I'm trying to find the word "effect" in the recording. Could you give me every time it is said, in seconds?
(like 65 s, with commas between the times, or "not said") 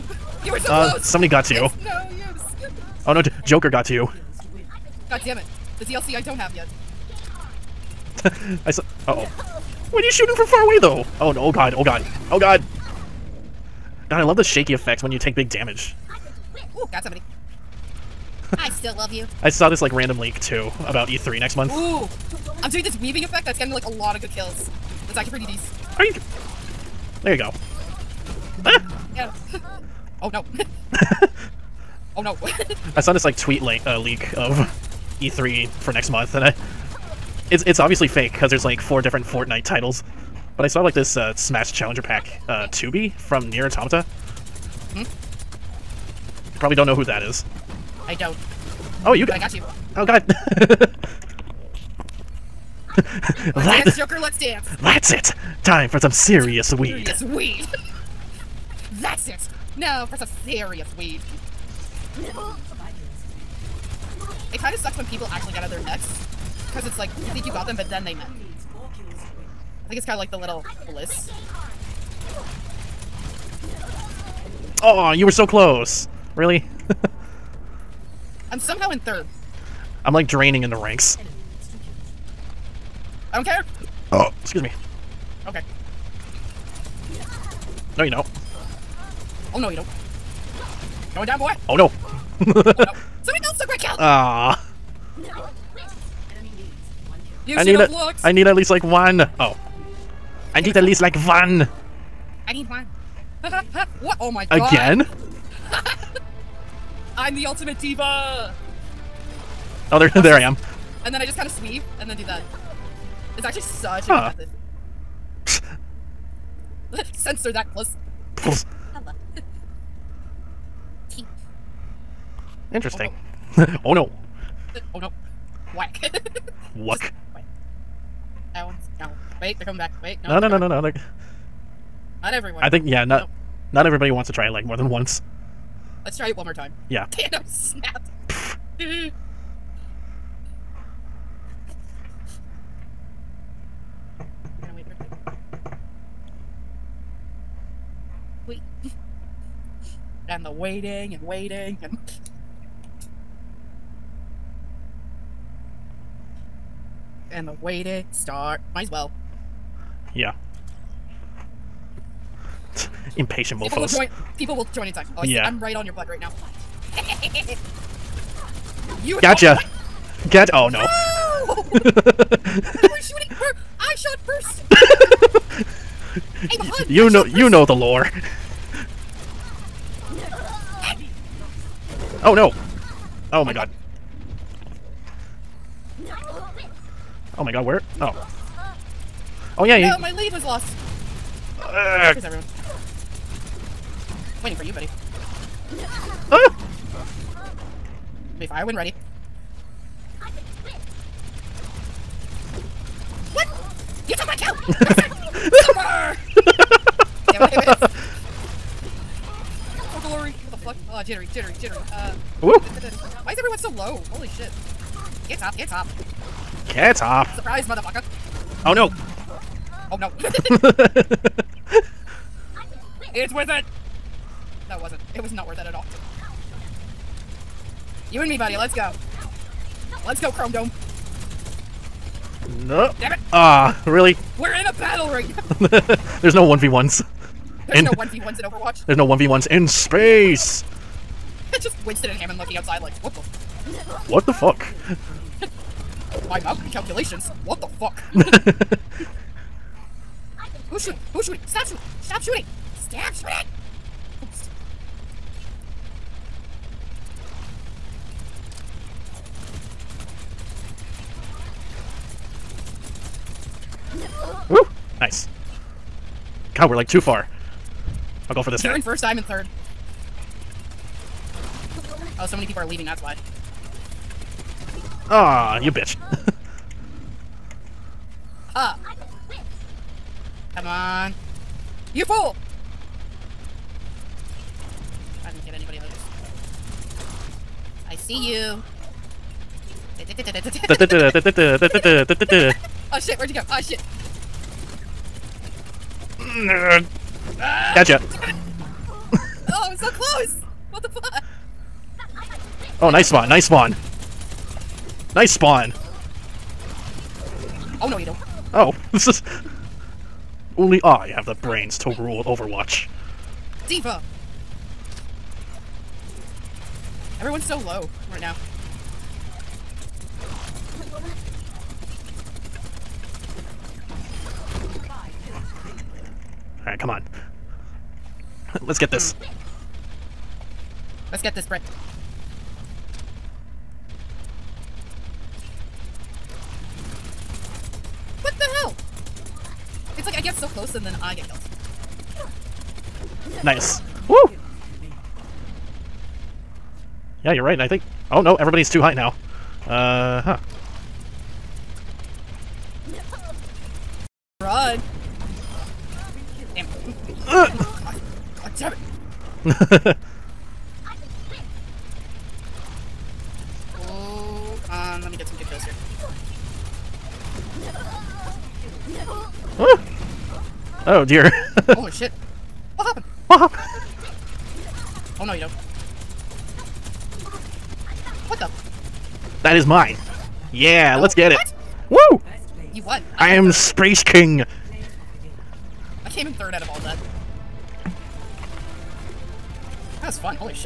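14 s, 23 s.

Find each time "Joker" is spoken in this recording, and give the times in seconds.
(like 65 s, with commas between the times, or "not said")
3 s, 53 s.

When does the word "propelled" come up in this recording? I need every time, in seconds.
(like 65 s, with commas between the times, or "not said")
not said.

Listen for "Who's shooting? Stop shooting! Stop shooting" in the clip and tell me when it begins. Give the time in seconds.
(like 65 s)
251 s.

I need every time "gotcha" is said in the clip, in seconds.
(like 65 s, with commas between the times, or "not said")
169 s, 297 s.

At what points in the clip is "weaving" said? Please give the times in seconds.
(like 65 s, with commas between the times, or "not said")
23 s.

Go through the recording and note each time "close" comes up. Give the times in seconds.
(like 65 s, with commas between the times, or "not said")
0 s, 75 s, 299 s, 340 s.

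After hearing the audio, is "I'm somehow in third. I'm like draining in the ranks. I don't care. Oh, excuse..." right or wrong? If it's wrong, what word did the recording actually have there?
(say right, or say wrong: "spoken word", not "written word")
right.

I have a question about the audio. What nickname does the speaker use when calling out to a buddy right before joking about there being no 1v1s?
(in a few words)
Chrome Dome.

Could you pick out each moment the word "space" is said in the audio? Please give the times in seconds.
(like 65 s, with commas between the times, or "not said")
239 s, 383 s.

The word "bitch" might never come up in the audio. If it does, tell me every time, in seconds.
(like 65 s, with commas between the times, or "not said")
275 s.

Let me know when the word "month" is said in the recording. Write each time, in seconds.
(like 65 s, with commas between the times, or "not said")
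21 s, 36 s.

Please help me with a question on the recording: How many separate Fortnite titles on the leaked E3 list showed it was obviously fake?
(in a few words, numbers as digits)
4.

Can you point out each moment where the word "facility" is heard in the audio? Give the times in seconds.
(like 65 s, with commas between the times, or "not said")
not said.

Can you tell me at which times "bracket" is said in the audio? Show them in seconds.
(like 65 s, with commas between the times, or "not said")
not said.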